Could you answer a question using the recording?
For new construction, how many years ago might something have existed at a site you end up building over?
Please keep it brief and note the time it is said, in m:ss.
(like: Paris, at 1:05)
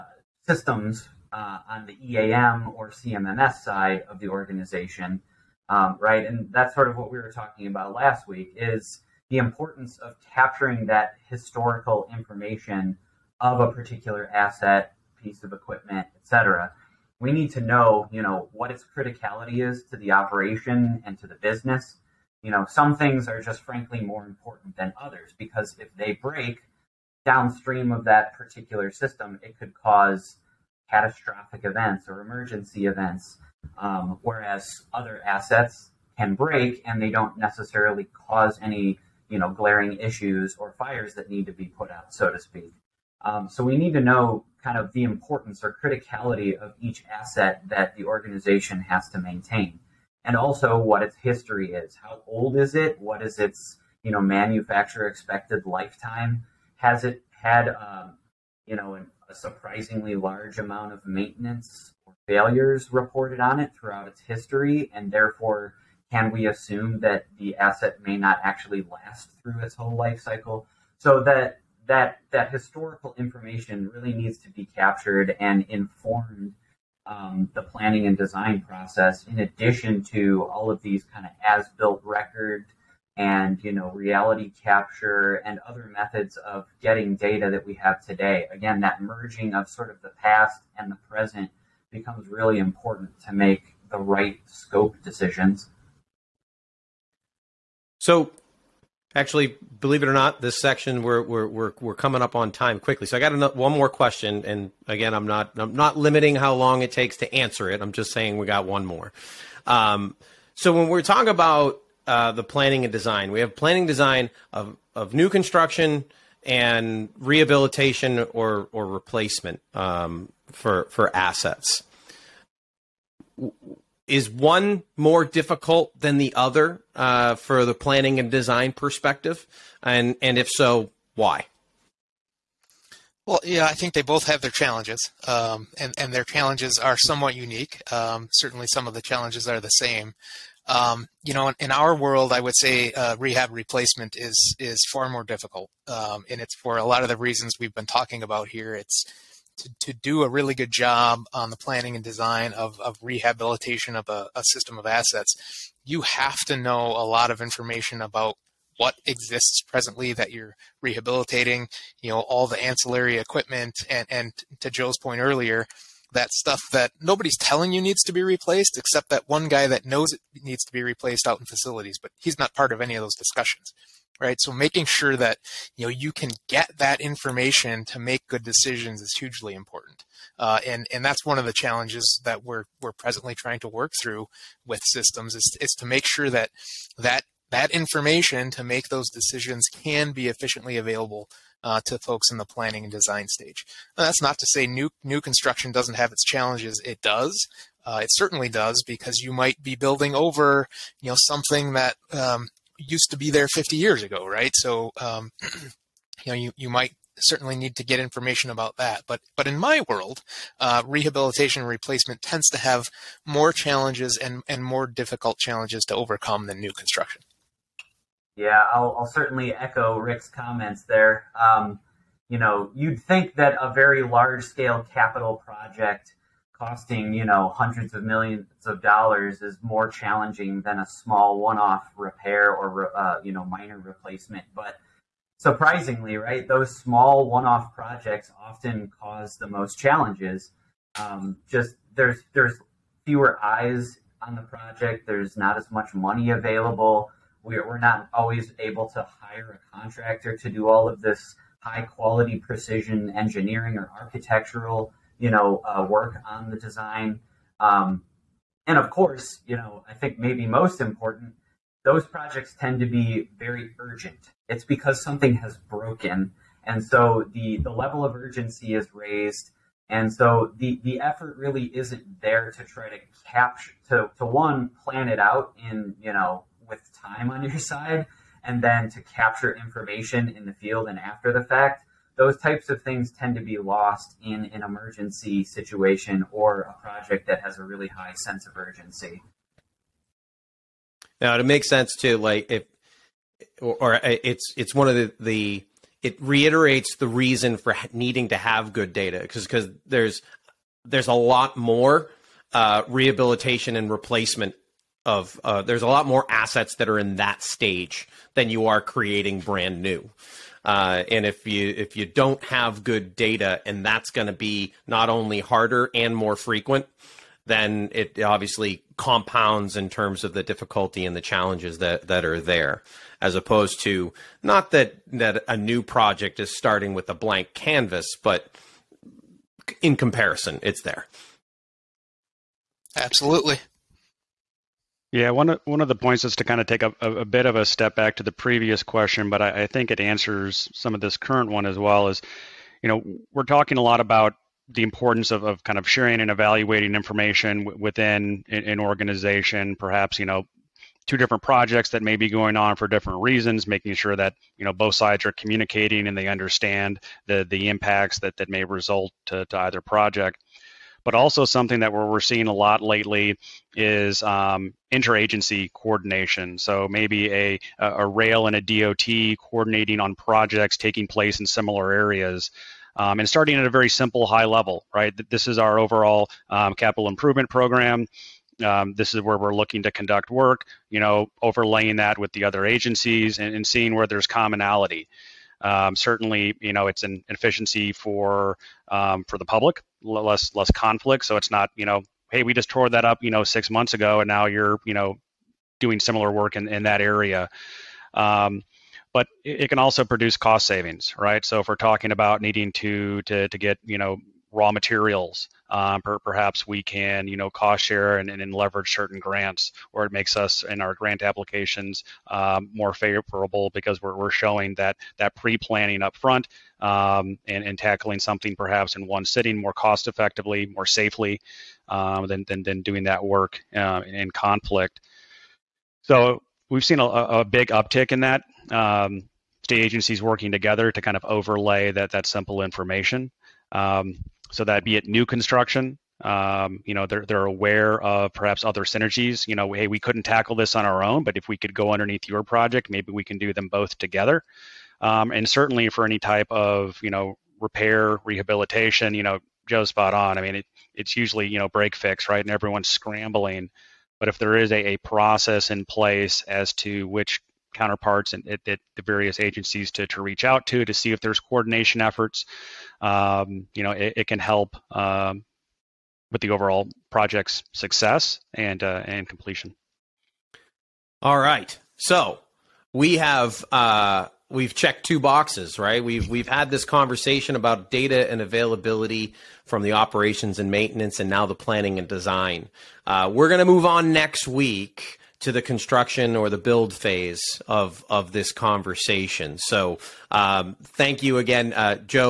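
50 years, at 3:23.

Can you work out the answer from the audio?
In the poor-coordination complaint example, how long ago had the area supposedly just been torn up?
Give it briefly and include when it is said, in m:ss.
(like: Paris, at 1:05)
6 months, at 6:33.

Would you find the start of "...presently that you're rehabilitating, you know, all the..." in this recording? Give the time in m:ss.
2:39.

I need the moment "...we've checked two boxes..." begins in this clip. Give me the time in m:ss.
7:54.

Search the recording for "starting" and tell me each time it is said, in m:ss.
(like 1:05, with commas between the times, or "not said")
5:26, 6:13.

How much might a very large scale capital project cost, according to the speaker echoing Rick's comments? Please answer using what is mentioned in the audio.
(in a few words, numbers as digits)
Hundreds of millions of dollars.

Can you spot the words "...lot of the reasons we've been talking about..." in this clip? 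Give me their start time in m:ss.
2:26.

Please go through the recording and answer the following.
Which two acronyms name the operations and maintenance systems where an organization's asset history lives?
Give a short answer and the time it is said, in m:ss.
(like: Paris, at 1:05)
EAM or CMMS, at 0:02.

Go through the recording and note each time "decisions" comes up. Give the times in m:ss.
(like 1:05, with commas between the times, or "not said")
1:35, 2:58, 3:09.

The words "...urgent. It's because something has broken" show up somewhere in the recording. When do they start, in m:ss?
4:23.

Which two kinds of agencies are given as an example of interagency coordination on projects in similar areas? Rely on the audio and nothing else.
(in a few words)
A rail and a DOT.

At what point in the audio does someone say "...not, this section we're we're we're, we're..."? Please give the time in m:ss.
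1:40.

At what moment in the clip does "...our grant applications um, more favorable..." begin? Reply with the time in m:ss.
6:50.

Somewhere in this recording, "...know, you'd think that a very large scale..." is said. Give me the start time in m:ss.
3:42.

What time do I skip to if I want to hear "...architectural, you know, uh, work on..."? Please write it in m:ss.
4:13.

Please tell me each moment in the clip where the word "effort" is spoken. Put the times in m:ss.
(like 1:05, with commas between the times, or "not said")
4:30, 7:42.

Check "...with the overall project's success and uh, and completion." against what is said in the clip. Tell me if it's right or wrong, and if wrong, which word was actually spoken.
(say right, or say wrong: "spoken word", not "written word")
right.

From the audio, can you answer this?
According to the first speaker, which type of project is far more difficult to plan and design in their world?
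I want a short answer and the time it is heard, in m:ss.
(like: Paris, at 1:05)
Rehab replacement, at 2:23.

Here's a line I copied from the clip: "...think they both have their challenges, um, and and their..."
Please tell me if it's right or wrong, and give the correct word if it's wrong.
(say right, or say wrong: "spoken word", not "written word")
right.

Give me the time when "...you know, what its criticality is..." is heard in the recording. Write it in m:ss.
0:18.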